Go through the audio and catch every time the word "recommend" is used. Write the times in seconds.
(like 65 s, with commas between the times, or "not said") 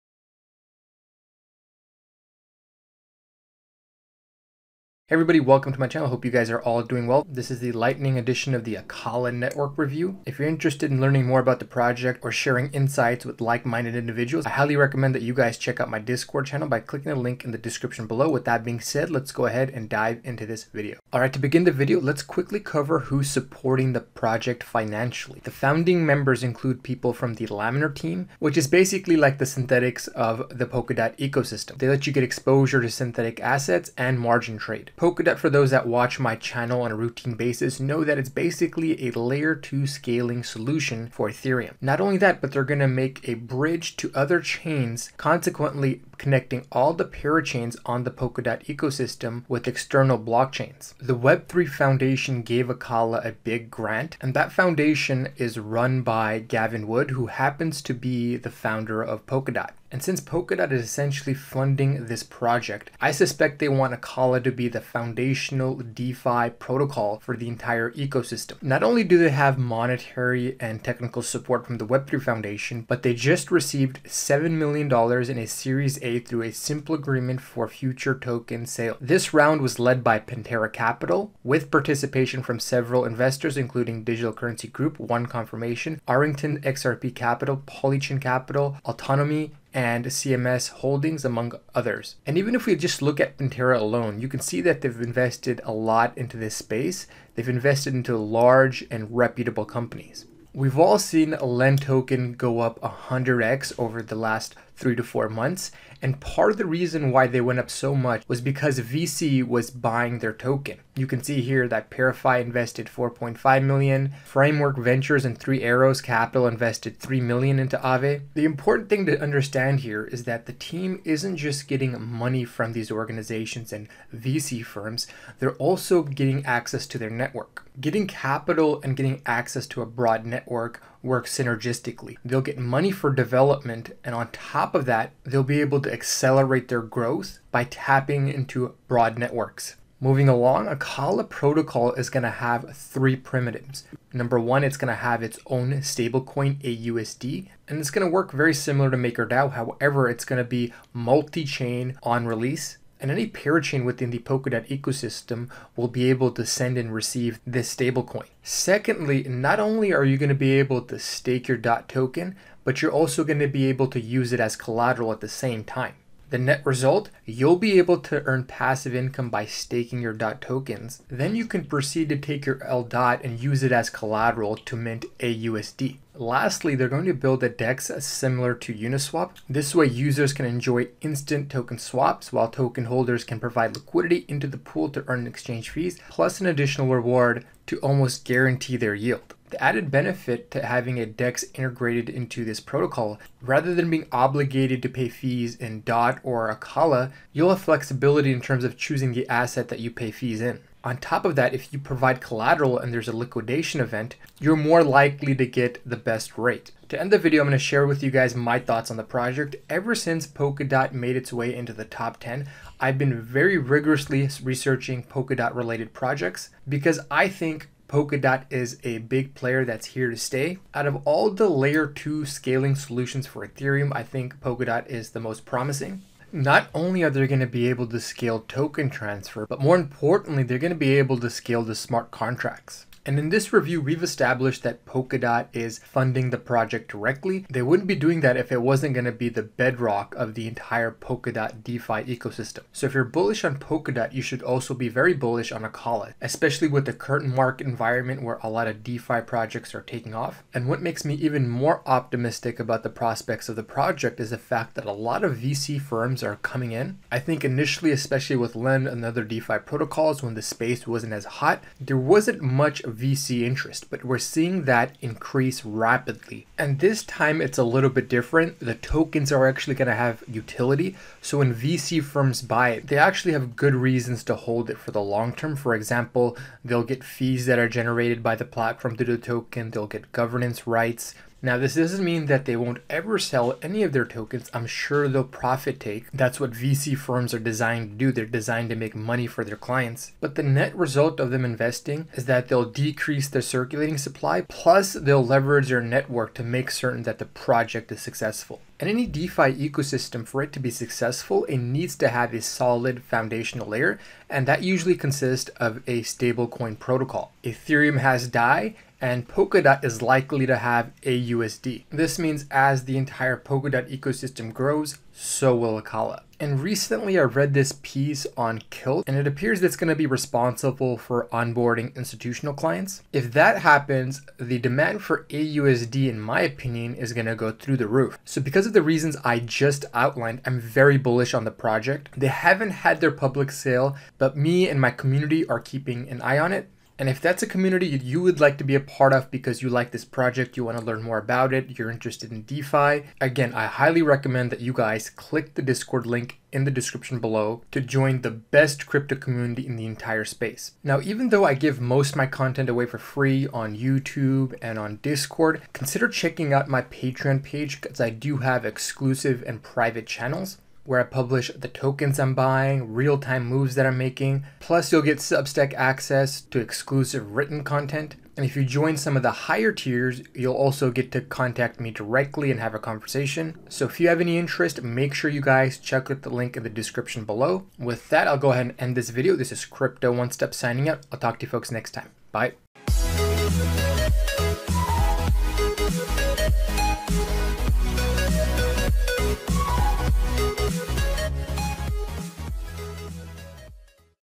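14 s, 344 s.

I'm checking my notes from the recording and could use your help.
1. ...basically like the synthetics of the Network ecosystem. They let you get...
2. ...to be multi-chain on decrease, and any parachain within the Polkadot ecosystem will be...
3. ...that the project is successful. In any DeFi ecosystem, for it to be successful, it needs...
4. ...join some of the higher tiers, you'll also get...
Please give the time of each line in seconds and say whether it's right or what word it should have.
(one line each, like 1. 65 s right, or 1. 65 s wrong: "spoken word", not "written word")
1. 28 s wrong: "Polkadot", not "Network"
2. 150 s wrong: "release", not "decrease"
3. 297 s right
4. 368 s right.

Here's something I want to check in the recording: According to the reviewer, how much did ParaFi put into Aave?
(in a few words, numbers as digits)
4.5 million.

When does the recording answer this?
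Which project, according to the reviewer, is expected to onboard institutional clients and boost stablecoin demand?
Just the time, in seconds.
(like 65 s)
318 s.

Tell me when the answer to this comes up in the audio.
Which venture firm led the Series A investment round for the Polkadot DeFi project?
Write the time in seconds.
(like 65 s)
80 s.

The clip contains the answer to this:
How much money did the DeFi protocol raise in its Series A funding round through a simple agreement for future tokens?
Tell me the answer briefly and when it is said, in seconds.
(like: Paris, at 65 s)
$7 million, at 74 s.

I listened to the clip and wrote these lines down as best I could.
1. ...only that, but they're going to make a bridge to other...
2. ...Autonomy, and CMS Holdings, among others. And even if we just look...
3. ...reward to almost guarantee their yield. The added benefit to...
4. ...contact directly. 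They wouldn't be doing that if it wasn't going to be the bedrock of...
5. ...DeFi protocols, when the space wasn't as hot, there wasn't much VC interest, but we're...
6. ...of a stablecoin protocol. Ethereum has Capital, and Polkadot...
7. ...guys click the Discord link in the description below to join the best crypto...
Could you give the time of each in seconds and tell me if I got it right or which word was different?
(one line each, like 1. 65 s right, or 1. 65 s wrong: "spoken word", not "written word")
1. 41 s right
2. 88 s right
3. 186 s right
4. 236 s wrong: "project", not "contact"
5. 259 s right
6. 305 s wrong: "DAI", not "Capital"
7. 344 s right.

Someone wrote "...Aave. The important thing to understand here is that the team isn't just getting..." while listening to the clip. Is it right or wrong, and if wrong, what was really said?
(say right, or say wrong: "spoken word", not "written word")
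right.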